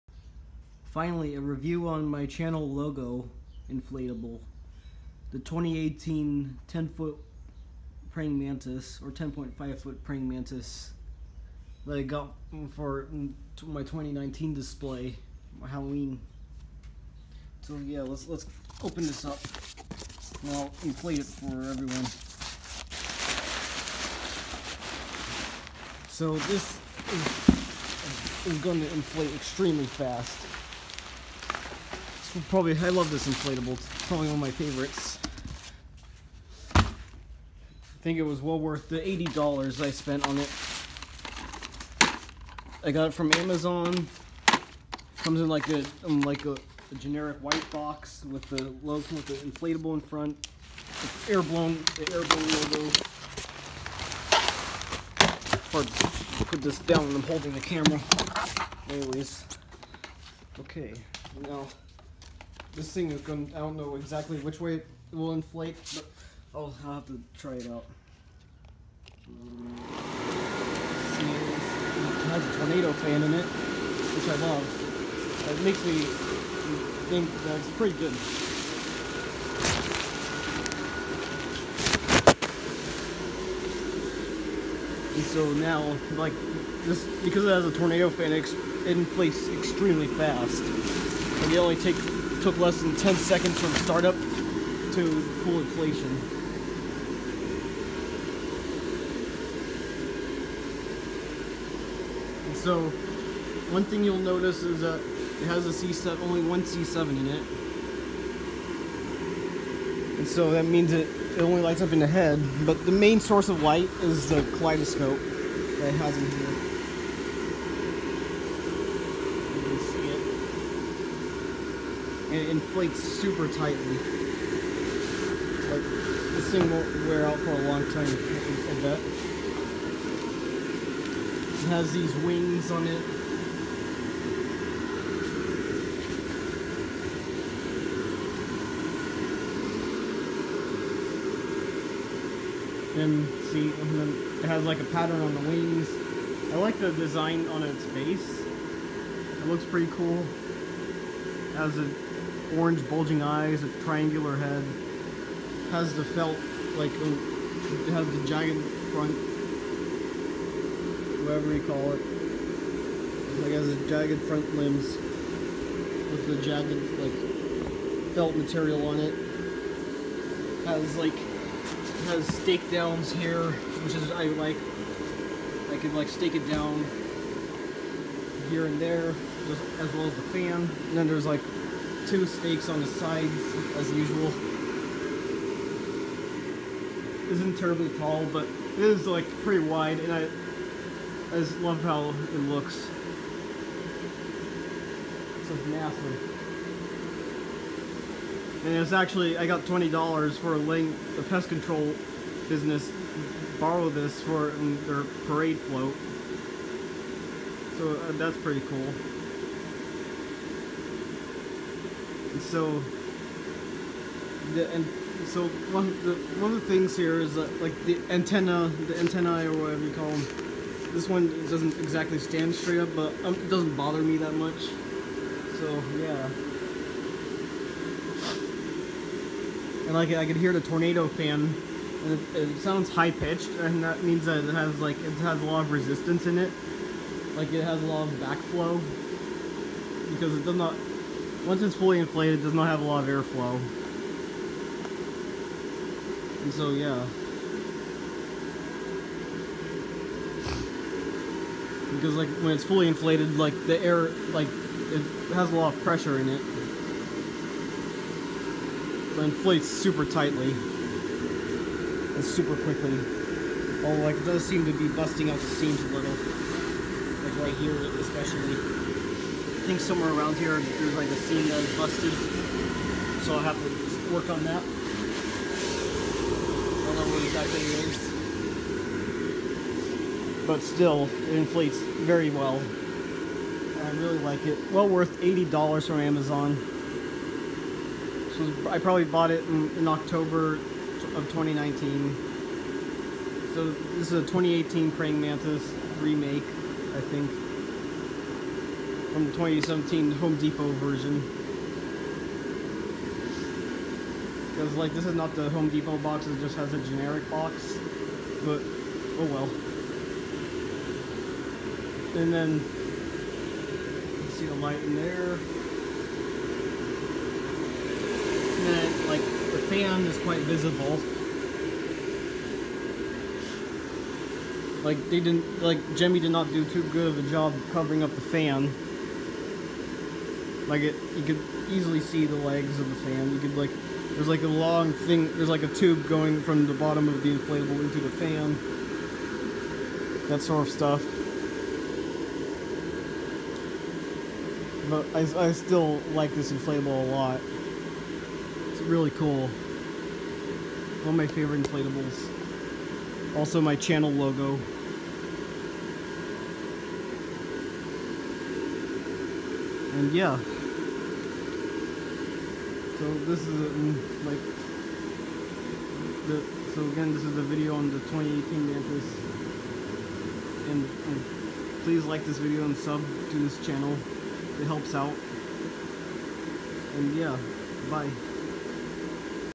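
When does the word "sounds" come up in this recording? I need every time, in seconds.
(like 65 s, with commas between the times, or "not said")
232 s.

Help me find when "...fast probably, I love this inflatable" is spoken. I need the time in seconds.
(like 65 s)
29 s.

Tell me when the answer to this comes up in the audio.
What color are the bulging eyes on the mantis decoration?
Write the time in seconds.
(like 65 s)
152 s.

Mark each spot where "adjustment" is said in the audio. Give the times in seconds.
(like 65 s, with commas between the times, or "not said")
not said.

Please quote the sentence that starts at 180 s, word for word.
And then there's, like, two stakes on the sides as usual.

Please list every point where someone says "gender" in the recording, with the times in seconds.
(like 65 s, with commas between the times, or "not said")
not said.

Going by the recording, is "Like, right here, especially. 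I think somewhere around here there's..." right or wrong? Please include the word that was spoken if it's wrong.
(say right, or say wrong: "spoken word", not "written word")
right.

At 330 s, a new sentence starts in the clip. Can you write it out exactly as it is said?
Like it, you could easily see the legs of the fan.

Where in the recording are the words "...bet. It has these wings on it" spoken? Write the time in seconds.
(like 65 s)
128 s.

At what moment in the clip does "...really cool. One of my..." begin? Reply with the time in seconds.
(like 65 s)
348 s.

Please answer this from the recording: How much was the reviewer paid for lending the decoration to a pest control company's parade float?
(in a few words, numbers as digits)
$20.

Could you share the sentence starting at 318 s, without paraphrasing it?
And then, like, the fan is quite visible.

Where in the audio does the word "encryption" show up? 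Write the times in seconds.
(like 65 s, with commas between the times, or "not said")
not said.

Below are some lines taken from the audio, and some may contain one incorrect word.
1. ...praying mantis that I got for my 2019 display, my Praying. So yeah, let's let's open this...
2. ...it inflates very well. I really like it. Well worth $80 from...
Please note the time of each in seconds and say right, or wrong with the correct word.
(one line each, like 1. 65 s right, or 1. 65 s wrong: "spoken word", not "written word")
1. 10 s wrong: "Halloween", not "Praying"
2. 281 s right.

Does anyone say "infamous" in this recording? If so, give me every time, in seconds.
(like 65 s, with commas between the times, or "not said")
not said.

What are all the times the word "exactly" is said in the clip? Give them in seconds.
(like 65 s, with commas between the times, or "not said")
63 s, 221 s, 277 s.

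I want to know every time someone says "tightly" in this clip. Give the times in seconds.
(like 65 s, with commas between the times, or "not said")
123 s, 260 s.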